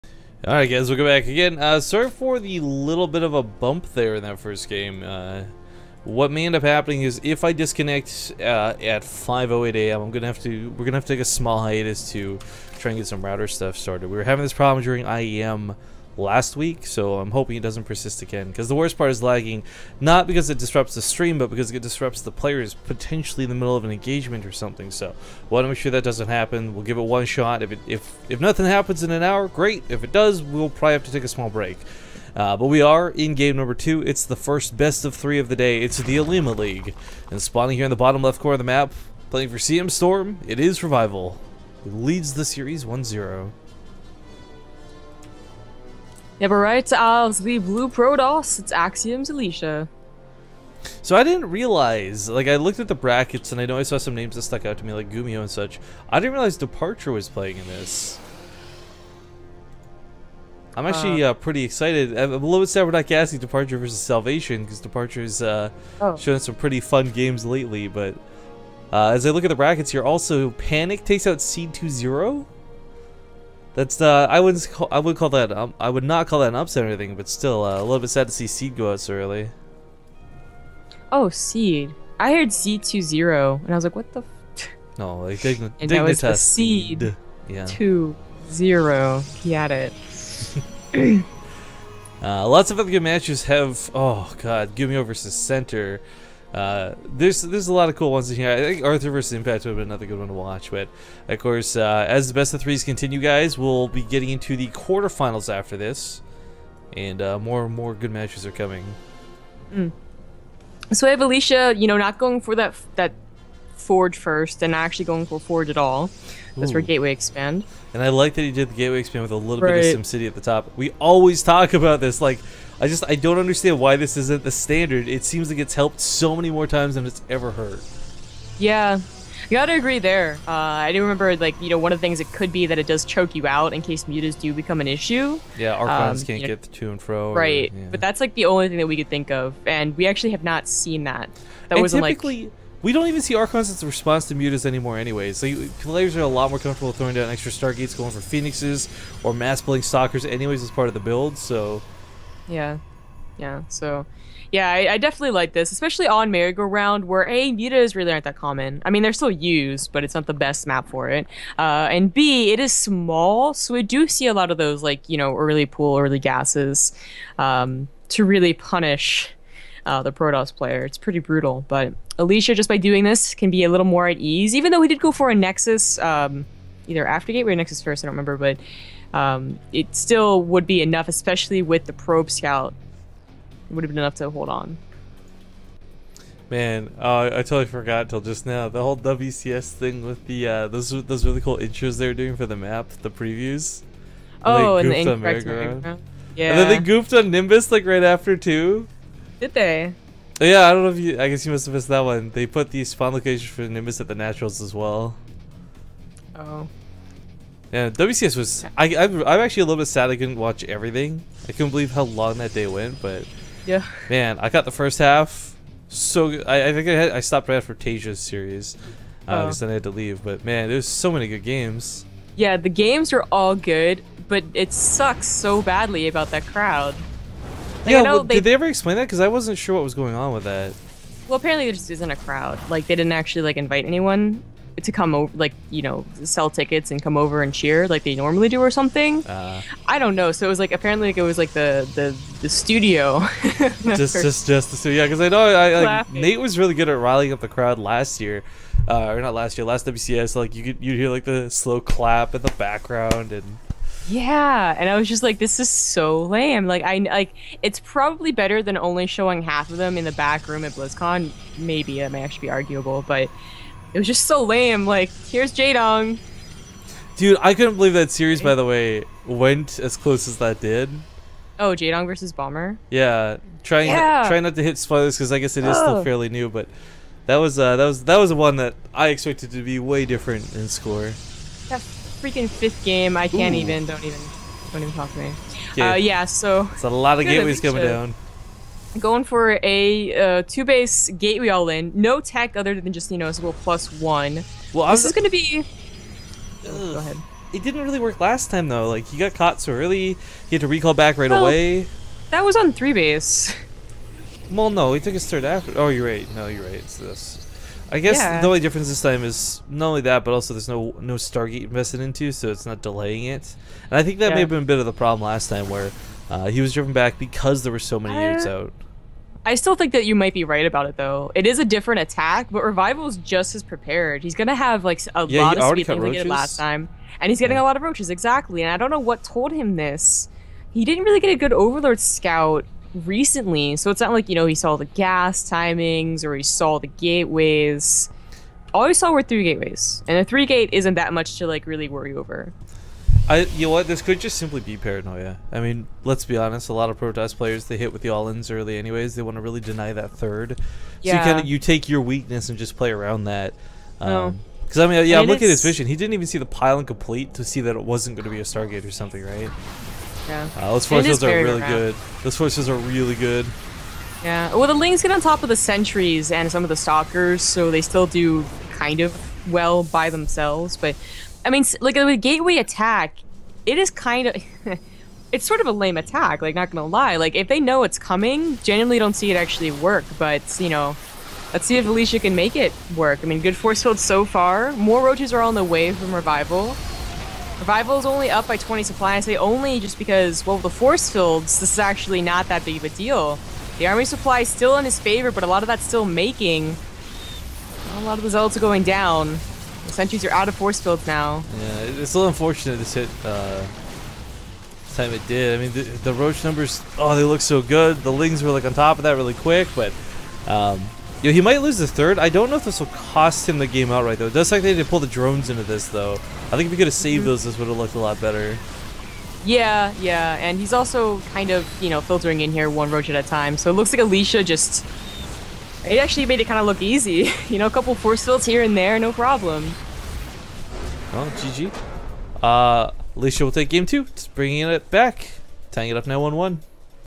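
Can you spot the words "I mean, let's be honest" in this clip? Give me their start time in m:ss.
5:45.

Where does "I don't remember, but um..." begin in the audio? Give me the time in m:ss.
2:58.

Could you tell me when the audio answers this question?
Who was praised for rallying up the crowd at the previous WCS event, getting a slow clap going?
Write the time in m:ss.
4:06.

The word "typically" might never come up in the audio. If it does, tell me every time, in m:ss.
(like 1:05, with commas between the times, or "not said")
2:22.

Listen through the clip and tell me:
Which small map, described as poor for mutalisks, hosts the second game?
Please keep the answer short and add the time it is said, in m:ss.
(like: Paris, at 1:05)
Merry-Go-Round, at 2:36.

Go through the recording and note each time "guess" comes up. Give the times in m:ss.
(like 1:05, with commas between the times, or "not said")
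3:21, 4:35, 5:07.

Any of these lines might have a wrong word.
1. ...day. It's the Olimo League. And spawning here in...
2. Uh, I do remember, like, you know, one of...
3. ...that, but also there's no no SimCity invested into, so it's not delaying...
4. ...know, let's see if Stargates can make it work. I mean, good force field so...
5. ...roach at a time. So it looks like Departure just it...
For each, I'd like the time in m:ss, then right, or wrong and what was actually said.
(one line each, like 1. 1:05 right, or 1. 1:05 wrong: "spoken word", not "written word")
1. 0:35 right
2. 2:10 right
3. 5:10 wrong: "Stargate", not "SimCity"
4. 6:20 wrong: "Alicia", not "Stargates"
5. 7:02 wrong: "Alicia", not "Departure".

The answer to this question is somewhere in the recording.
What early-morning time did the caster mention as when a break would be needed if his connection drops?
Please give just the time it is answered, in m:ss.
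0:09.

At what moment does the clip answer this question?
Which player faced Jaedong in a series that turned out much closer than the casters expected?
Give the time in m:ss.
4:32.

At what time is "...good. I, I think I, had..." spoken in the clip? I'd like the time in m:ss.
3:36.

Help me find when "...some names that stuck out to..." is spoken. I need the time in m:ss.
0:53.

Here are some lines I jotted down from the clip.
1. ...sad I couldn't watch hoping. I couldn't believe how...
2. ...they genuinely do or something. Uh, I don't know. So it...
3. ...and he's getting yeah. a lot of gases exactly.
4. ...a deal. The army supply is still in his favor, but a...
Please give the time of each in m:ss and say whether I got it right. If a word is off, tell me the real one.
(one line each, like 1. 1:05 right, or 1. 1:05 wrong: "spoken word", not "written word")
1. 3:29 wrong: "everything", not "hoping"
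2. 3:58 wrong: "normally", not "genuinely"
3. 5:27 wrong: "roaches", not "gases"
4. 6:32 right.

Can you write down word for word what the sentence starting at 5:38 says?
All he saw were three gateways, and a three gate isn't that much to like really worry over.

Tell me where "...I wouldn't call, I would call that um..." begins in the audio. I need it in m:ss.
1:14.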